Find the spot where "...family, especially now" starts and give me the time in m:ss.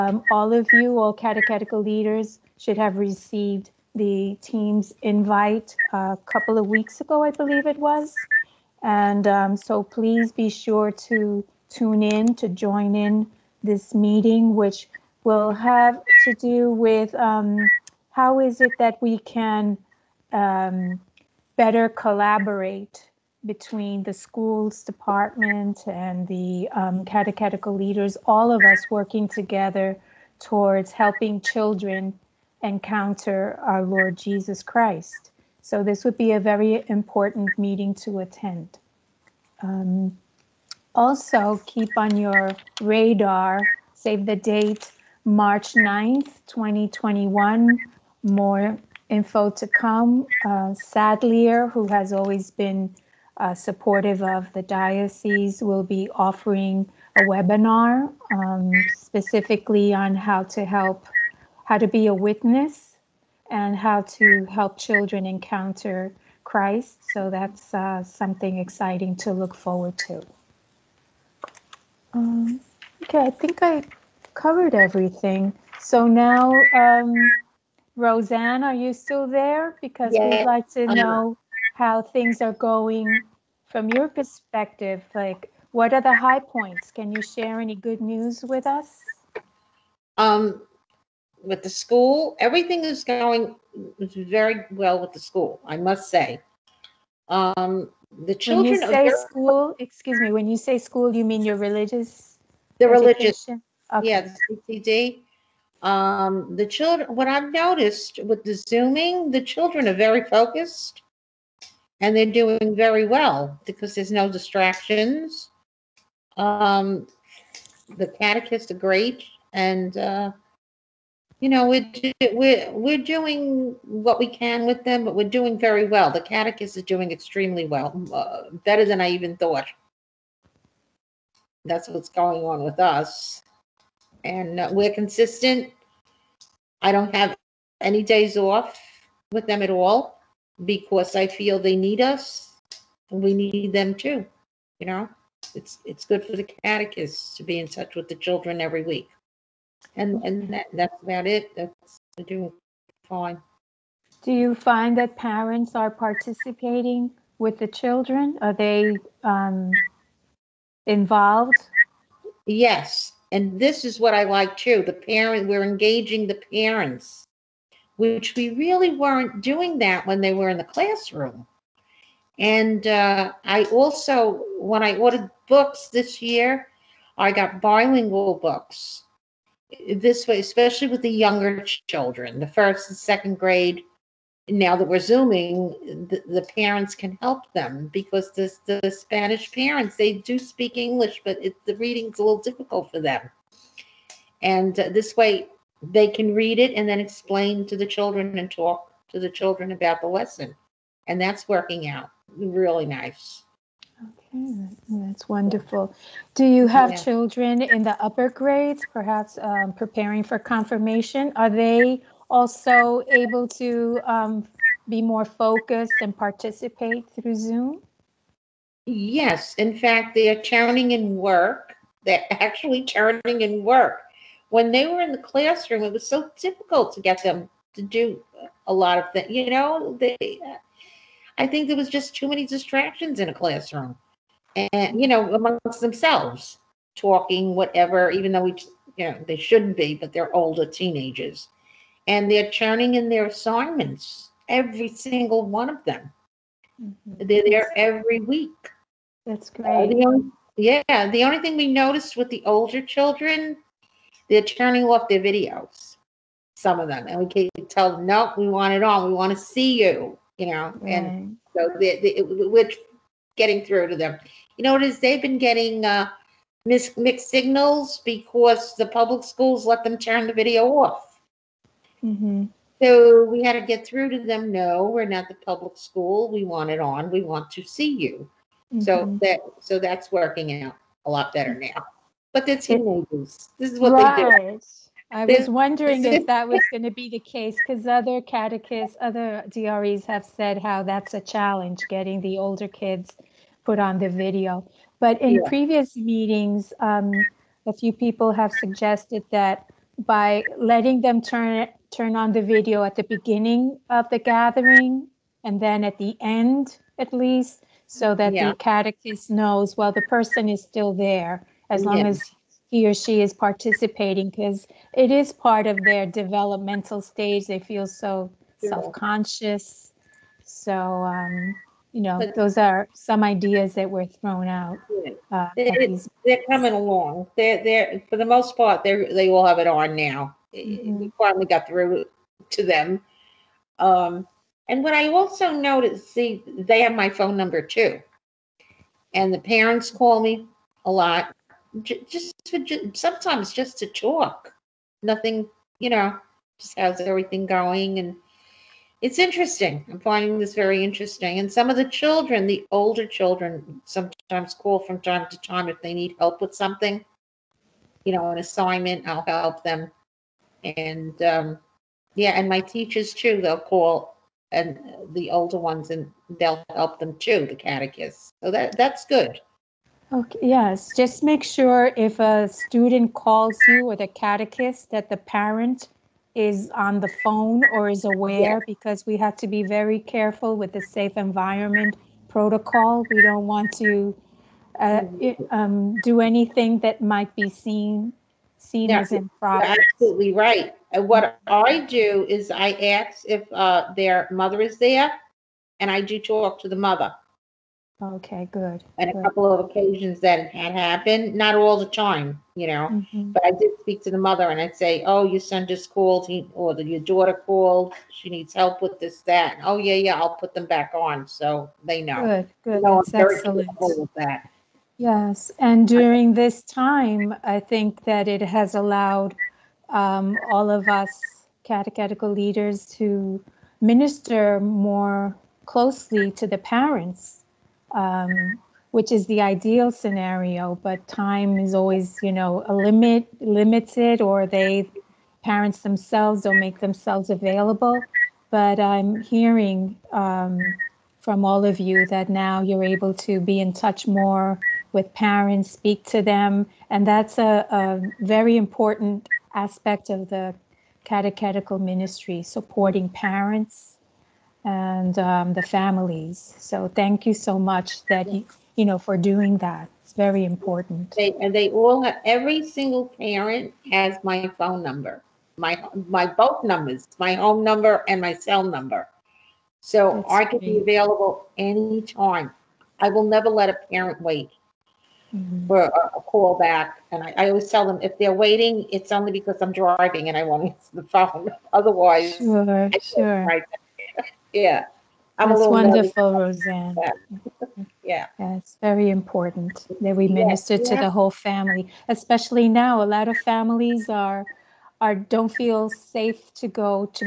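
8:11.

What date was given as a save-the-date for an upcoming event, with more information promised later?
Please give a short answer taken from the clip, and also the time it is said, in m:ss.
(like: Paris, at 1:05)
March 9, 2021, at 0:45.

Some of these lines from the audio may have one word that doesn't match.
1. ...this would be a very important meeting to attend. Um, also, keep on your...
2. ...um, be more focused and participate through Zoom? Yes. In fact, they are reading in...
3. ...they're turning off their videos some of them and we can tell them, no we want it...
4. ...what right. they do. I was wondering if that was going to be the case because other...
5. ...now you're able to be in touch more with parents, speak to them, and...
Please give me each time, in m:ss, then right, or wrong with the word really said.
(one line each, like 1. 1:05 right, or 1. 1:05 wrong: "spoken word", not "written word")
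1. 0:35 right
2. 3:34 wrong: "turning", not "reading"
3. 4:14 right
4. 4:43 right
5. 7:22 right.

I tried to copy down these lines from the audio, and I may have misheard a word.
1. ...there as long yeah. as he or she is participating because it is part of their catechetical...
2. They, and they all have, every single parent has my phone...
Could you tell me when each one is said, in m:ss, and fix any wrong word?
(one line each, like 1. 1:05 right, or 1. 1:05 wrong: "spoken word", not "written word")
1. 5:10 wrong: "developmental", not "catechetical"
2. 7:41 right.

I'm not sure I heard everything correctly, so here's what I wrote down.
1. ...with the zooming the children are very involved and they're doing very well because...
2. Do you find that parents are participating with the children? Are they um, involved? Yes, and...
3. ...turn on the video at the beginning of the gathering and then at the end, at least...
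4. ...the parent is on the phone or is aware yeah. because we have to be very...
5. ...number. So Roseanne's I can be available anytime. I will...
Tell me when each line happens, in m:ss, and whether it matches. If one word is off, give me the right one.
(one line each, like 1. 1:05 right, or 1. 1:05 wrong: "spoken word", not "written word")
1. 1:48 wrong: "focused", not "involved"
2. 2:34 right
3. 5:01 right
4. 6:15 right
5. 7:48 wrong: "That", not "Roseanne".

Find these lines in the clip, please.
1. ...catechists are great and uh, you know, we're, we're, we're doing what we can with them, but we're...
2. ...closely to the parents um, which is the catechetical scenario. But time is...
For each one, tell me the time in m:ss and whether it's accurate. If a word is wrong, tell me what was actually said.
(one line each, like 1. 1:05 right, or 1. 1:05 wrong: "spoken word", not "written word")
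1. 1:58 right
2. 7:05 wrong: "ideal", not "catechetical".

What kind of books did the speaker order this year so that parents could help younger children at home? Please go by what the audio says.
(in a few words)
Bilingual books.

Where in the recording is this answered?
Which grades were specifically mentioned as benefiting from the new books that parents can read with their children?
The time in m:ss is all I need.
3:02.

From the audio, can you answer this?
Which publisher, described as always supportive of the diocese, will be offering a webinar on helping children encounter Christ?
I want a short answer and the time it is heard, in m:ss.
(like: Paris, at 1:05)
Sadlier, at 0:50.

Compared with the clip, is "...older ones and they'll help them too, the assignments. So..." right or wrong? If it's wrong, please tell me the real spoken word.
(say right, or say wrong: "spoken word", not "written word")
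wrong: "catechists", not "assignments".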